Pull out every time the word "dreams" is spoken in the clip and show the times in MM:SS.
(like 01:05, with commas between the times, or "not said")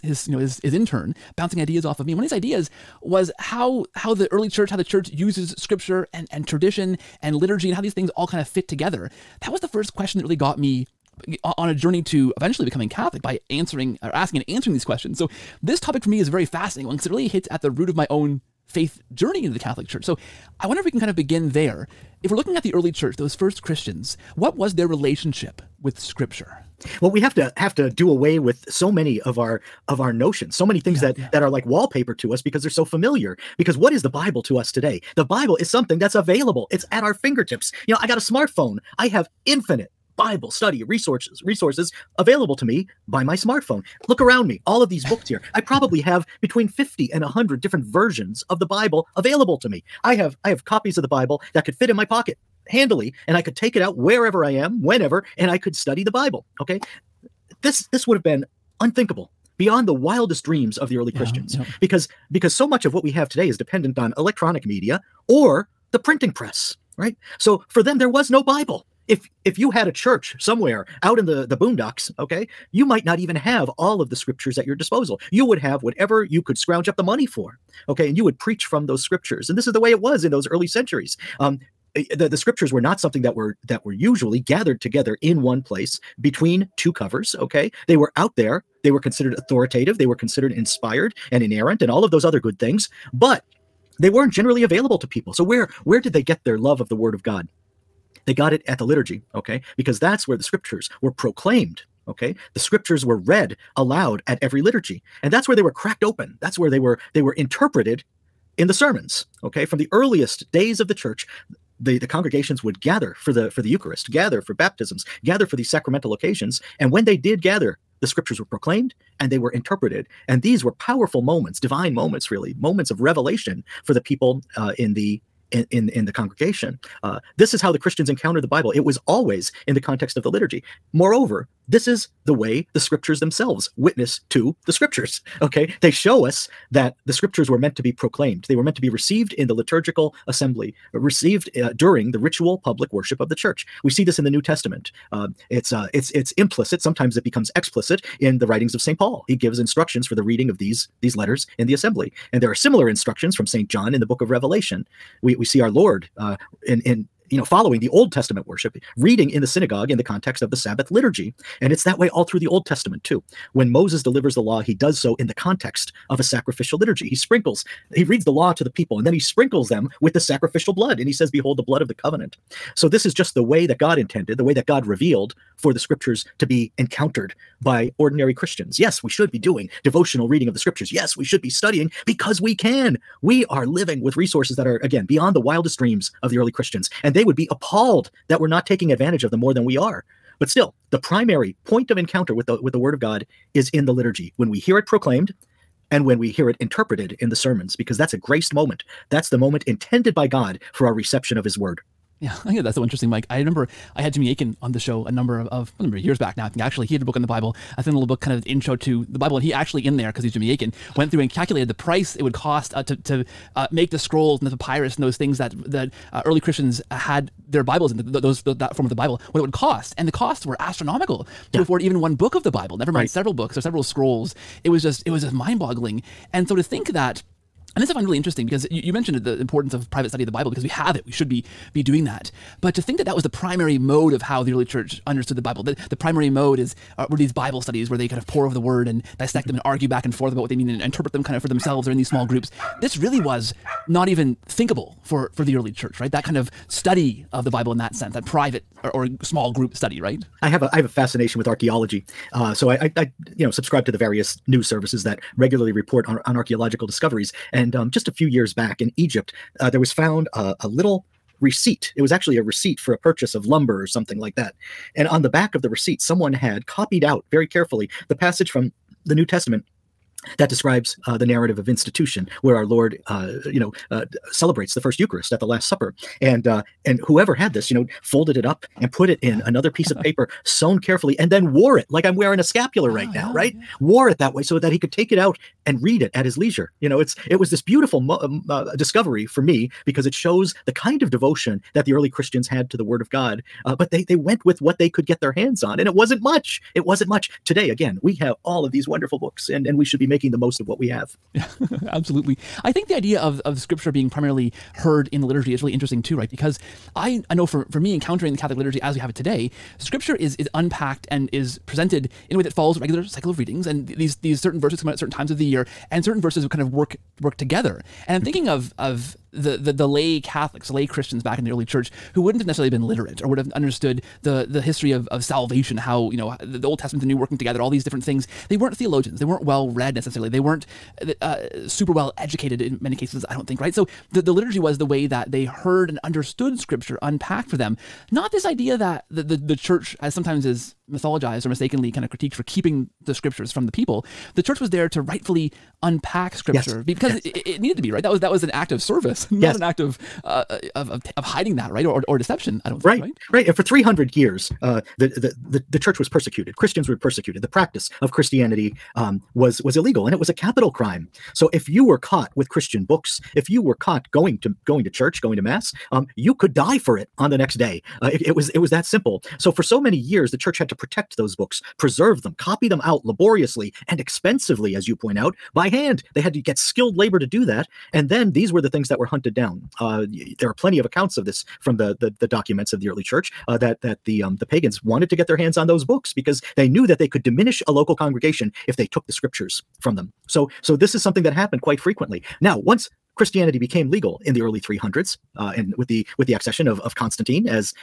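01:00, 03:05.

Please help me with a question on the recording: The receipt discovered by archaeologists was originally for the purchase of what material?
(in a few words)
Lumber.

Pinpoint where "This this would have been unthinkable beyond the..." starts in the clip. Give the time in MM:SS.
00:57.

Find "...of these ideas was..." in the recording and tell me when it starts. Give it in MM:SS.
00:02.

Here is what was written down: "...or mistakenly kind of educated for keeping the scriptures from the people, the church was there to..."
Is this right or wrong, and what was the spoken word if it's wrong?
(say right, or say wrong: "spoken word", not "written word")
wrong: "critiqued", not "educated".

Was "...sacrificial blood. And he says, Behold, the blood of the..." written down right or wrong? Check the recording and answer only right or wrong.
right.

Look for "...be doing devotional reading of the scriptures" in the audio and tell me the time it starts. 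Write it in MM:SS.
02:59.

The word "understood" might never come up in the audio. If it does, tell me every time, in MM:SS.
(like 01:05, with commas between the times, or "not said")
03:55, 05:23, 05:36.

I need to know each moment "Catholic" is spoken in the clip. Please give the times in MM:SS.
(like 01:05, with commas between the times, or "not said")
00:12, 00:19, 05:08, 05:20.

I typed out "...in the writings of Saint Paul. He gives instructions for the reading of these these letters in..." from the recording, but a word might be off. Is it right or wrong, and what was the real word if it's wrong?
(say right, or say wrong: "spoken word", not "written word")
right.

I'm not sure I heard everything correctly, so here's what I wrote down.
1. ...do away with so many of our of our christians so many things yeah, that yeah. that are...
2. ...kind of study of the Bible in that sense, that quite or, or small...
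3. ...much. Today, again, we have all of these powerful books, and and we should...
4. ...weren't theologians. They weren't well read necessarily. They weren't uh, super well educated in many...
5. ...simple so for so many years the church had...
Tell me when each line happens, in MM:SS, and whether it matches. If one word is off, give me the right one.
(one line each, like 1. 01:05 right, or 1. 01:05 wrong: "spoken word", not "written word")
1. 00:27 wrong: "notions", not "christians"
2. 04:06 wrong: "private", not "quite"
3. 04:57 wrong: "wonderful", not "powerful"
4. 05:28 right
5. 06:08 right.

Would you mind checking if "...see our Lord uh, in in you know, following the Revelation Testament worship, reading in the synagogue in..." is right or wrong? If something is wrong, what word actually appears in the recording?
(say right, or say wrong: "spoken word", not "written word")
wrong: "Old", not "Revelation".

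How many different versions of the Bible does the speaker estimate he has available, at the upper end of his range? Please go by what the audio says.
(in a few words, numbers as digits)
100.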